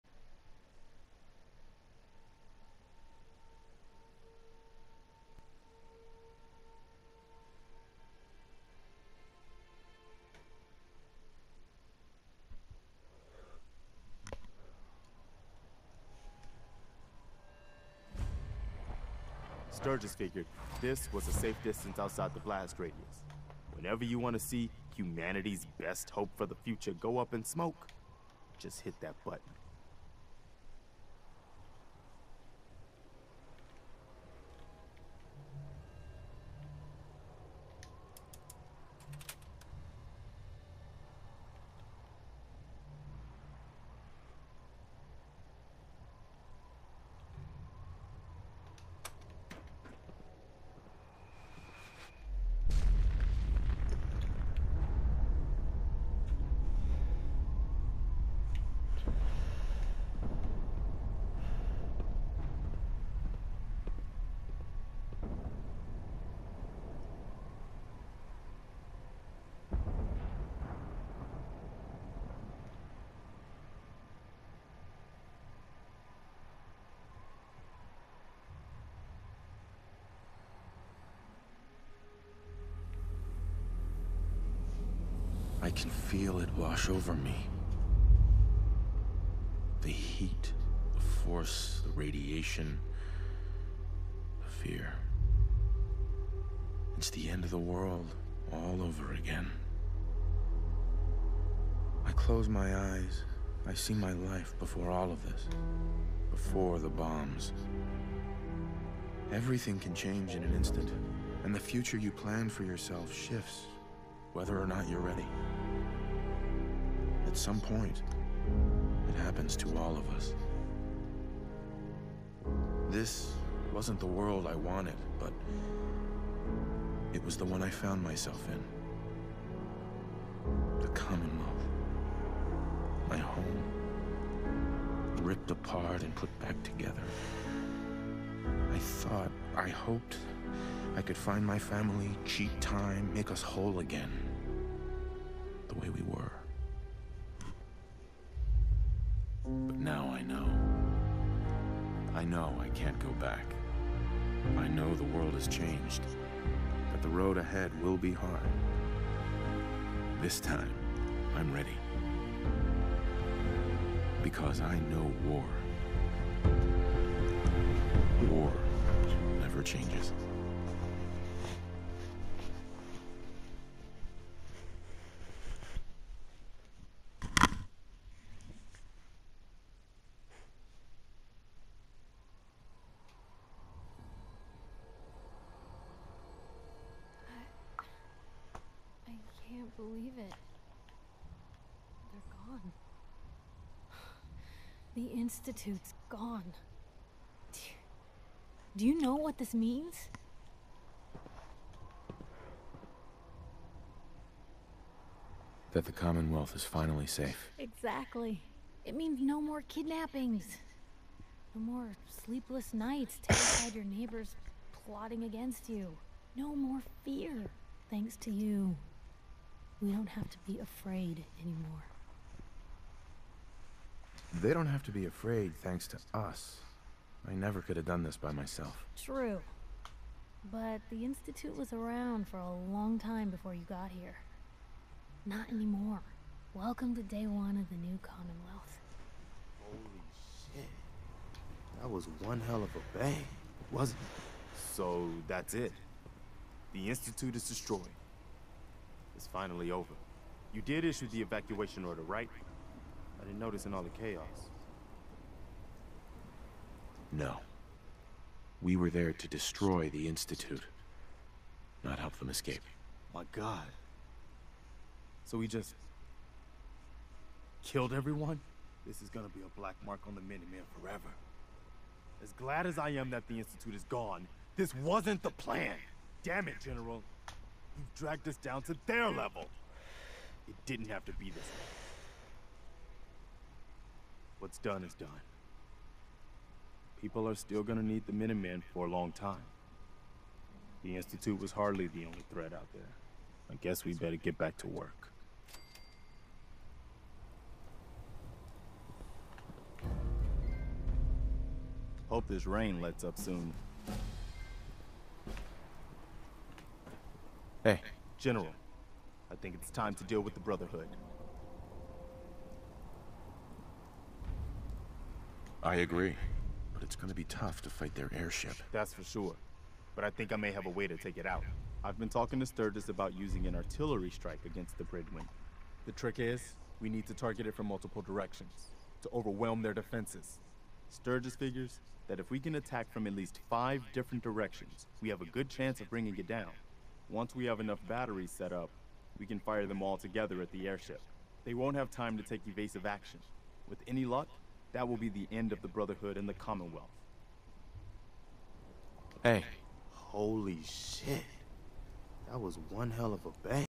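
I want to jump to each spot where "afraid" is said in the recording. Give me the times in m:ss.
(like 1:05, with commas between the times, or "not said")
3:40, 3:45.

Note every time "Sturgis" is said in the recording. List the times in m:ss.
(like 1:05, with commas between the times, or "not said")
0:19, 5:22, 5:30.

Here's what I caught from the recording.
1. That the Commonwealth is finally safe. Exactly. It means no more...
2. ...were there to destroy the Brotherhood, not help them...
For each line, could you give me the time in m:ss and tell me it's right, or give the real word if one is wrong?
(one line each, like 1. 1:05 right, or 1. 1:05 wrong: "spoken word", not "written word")
1. 3:25 right
2. 4:18 wrong: "Institute", not "Brotherhood".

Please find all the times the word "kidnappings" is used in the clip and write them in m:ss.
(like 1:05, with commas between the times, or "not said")
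3:29.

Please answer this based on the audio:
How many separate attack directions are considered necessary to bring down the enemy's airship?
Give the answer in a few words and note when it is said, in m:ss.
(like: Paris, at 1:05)
5, at 5:33.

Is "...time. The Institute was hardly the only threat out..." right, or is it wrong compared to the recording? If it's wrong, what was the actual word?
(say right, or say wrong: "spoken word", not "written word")
right.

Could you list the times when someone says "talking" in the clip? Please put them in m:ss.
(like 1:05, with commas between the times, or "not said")
5:22.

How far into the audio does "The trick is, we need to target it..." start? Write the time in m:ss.
5:25.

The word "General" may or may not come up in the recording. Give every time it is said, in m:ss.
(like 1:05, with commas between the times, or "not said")
4:36, 5:08.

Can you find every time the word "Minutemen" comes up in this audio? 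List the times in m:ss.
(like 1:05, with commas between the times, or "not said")
4:30, 4:48.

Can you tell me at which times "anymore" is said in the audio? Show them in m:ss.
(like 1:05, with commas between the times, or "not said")
3:41, 3:55.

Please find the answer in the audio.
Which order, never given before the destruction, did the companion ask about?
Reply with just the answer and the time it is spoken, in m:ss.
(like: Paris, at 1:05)
evacuation order, at 4:11.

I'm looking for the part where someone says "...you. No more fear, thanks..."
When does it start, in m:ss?
3:35.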